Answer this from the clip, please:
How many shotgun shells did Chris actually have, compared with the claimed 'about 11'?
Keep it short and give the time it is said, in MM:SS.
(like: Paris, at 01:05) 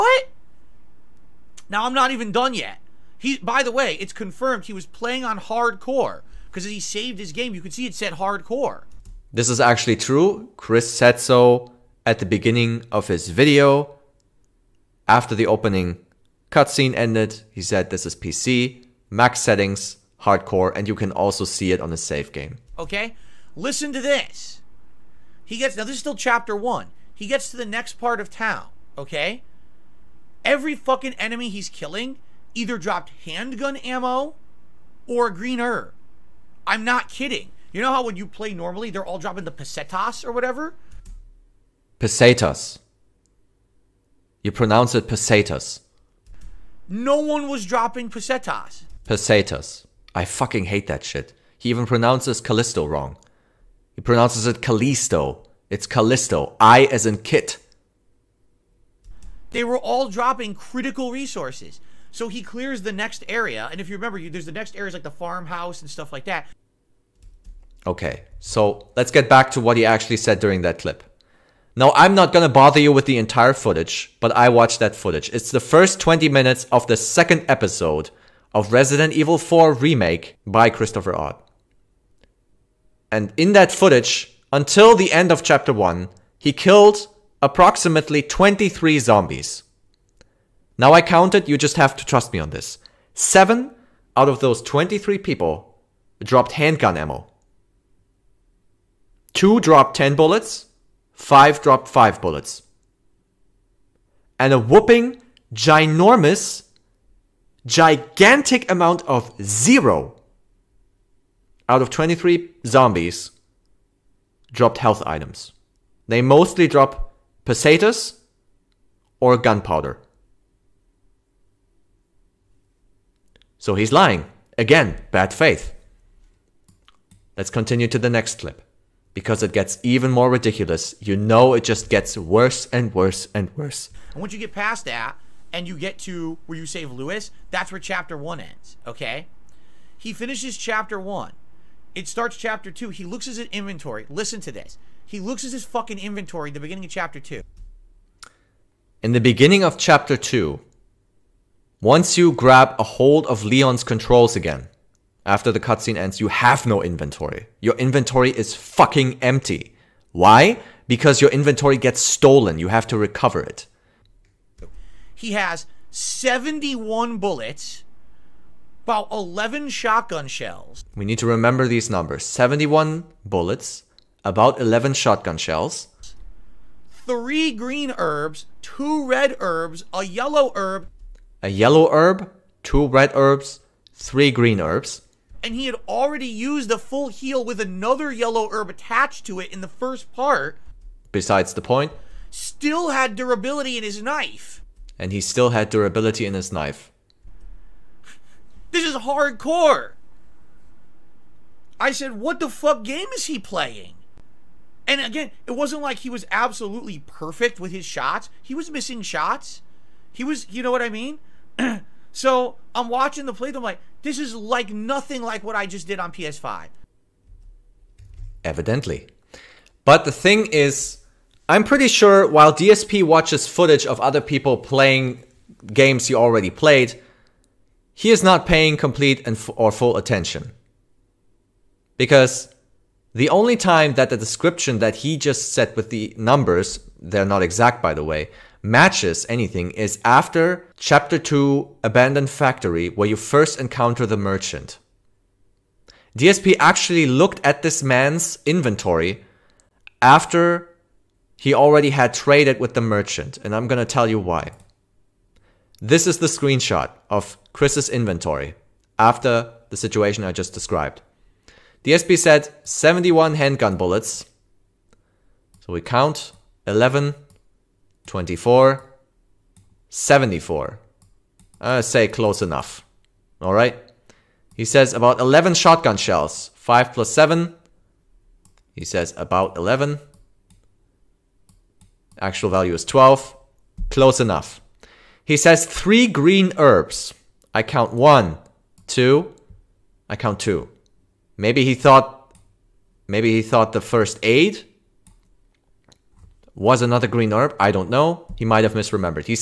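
12, at 04:42.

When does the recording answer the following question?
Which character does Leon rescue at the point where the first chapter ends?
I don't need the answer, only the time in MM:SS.
02:16.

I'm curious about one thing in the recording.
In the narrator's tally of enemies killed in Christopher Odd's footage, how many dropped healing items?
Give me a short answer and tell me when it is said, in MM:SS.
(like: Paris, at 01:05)
0, at 01:49.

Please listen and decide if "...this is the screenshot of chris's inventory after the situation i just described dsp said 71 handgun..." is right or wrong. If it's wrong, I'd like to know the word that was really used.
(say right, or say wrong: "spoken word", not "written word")
right.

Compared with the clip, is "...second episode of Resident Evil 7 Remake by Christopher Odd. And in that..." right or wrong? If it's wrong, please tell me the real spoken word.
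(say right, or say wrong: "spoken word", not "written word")
wrong: "4", not "7".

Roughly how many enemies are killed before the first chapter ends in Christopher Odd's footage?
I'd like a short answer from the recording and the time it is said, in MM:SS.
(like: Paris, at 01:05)
23, at 01:27.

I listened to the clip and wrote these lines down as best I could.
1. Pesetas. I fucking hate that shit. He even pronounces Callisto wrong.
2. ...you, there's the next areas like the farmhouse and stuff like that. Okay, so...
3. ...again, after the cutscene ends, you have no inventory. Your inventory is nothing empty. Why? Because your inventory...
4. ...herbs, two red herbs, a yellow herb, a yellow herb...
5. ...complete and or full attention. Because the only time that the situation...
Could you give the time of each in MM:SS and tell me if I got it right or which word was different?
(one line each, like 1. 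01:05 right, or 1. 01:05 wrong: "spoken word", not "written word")
1. 00:49 right
2. 01:04 right
3. 02:34 wrong: "fucking", not "nothing"
4. 02:57 right
5. 03:48 wrong: "description", not "situation".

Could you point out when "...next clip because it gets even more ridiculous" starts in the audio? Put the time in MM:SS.
02:08.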